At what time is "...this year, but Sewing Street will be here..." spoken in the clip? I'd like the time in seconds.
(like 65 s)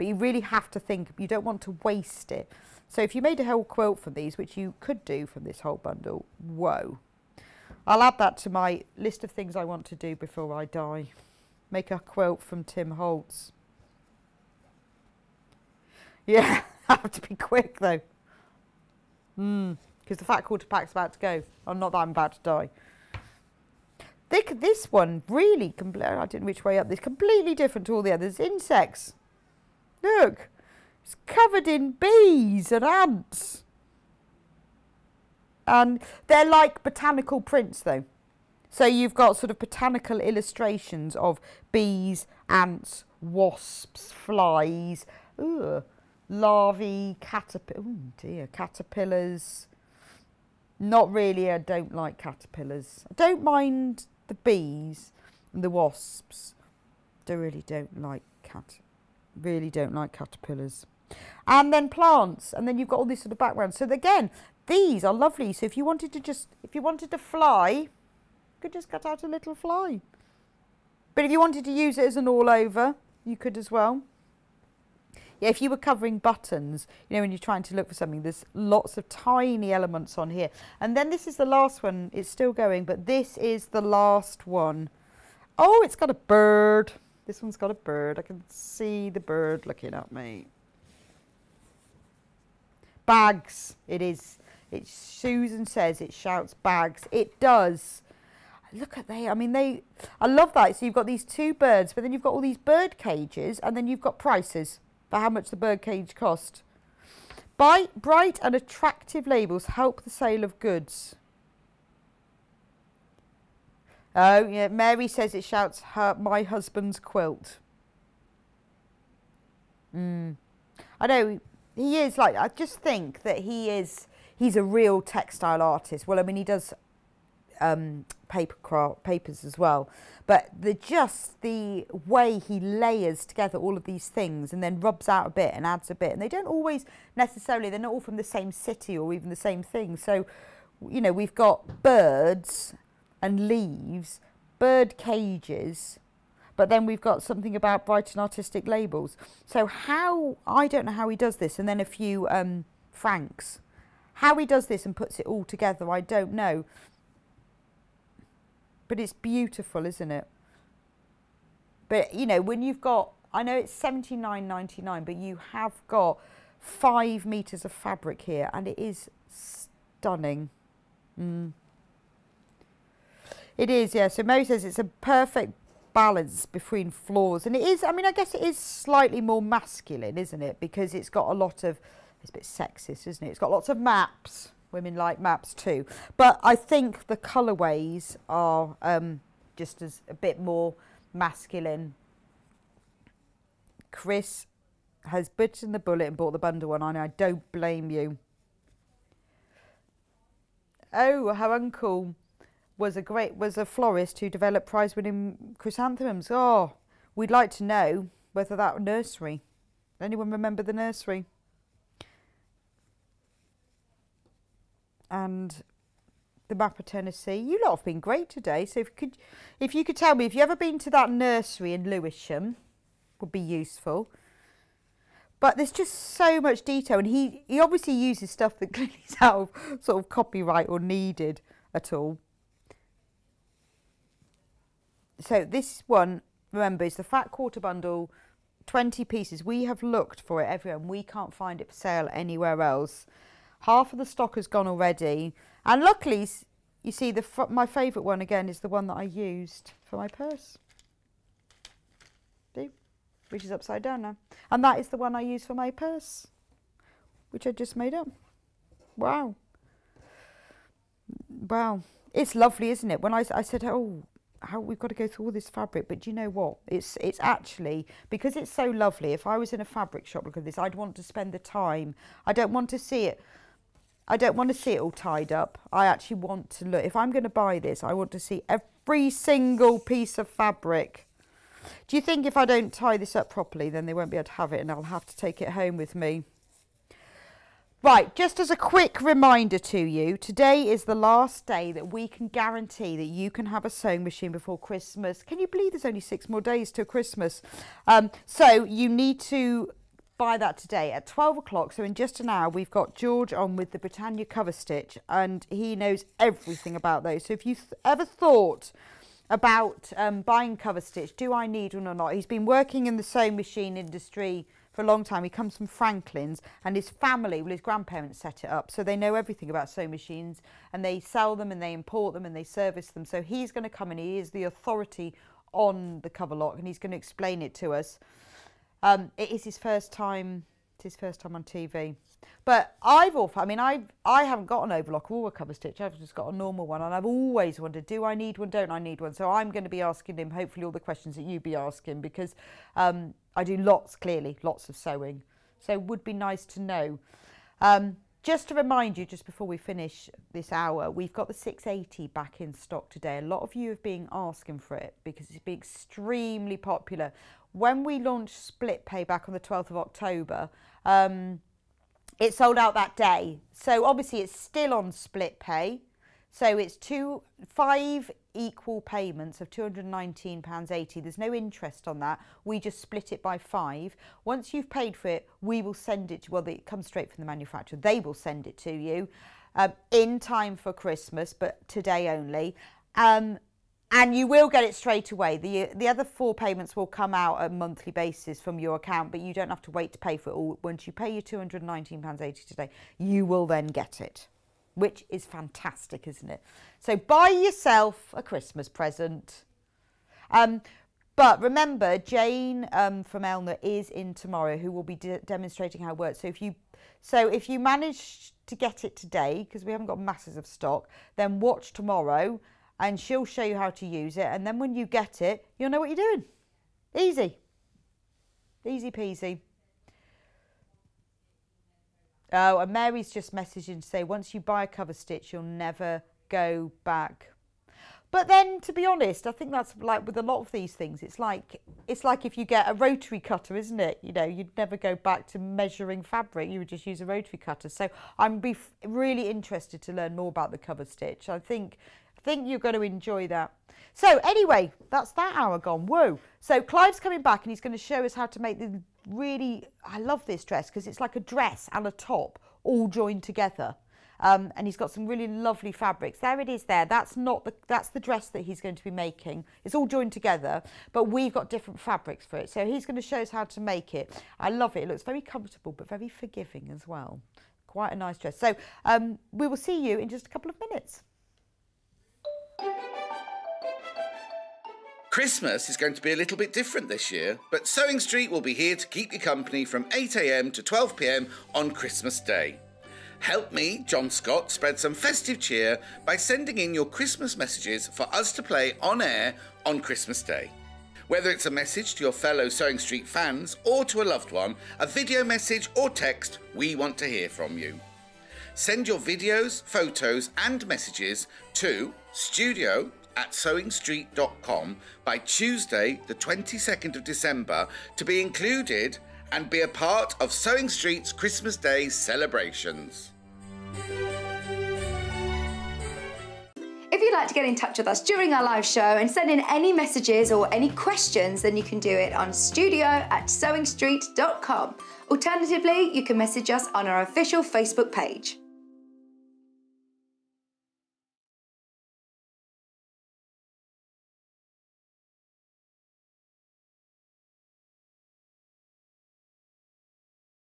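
476 s.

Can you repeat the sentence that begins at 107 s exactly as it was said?
Bright, bright and attractive labels help the sale of goods.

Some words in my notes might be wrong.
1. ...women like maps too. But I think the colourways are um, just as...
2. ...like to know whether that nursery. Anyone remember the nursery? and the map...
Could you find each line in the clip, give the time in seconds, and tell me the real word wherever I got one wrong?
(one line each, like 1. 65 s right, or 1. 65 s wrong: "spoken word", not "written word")
1. 184 s right
2. 207 s right.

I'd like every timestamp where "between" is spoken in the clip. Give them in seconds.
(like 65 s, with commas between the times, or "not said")
176 s.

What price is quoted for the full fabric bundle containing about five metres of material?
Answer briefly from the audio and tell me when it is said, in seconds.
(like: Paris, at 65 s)
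79.99, at 163 s.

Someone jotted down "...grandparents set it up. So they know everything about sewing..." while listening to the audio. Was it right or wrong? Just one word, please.
right.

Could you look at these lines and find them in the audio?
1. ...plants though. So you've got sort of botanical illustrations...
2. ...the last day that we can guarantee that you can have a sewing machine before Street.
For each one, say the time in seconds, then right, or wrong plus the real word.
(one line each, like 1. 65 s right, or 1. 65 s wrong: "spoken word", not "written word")
1. 37 s wrong: "prints", not "plants"
2. 290 s wrong: "Christmas", not "Street".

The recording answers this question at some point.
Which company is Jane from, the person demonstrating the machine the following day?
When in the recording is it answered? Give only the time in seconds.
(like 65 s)
403 s.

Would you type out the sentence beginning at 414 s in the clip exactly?
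And then when you get it, you'll know what you're doing.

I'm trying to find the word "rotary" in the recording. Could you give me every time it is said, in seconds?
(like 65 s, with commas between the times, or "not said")
432 s, 437 s.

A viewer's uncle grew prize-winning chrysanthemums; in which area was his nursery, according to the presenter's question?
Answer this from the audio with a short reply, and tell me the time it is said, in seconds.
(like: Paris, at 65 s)
Lewisham, at 221 s.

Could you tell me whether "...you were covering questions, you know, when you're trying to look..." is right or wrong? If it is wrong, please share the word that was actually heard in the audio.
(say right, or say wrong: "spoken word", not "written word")
wrong: "buttons", not "questions".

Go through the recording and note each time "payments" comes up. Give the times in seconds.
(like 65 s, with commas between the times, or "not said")
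368 s, 386 s.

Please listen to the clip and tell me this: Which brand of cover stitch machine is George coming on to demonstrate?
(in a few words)
Britannia.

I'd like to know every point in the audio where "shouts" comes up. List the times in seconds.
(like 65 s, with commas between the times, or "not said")
96 s, 115 s.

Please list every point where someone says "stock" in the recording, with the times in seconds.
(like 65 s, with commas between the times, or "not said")
244 s, 352 s, 410 s.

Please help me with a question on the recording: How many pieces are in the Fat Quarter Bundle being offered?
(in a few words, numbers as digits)
20.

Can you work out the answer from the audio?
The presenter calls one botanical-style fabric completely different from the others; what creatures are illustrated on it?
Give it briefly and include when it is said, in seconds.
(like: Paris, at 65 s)
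Insects, at 28 s.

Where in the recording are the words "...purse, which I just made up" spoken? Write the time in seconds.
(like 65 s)
255 s.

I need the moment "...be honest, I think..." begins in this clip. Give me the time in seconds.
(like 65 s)
428 s.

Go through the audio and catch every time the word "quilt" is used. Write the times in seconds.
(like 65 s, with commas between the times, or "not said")
3 s, 11 s, 116 s.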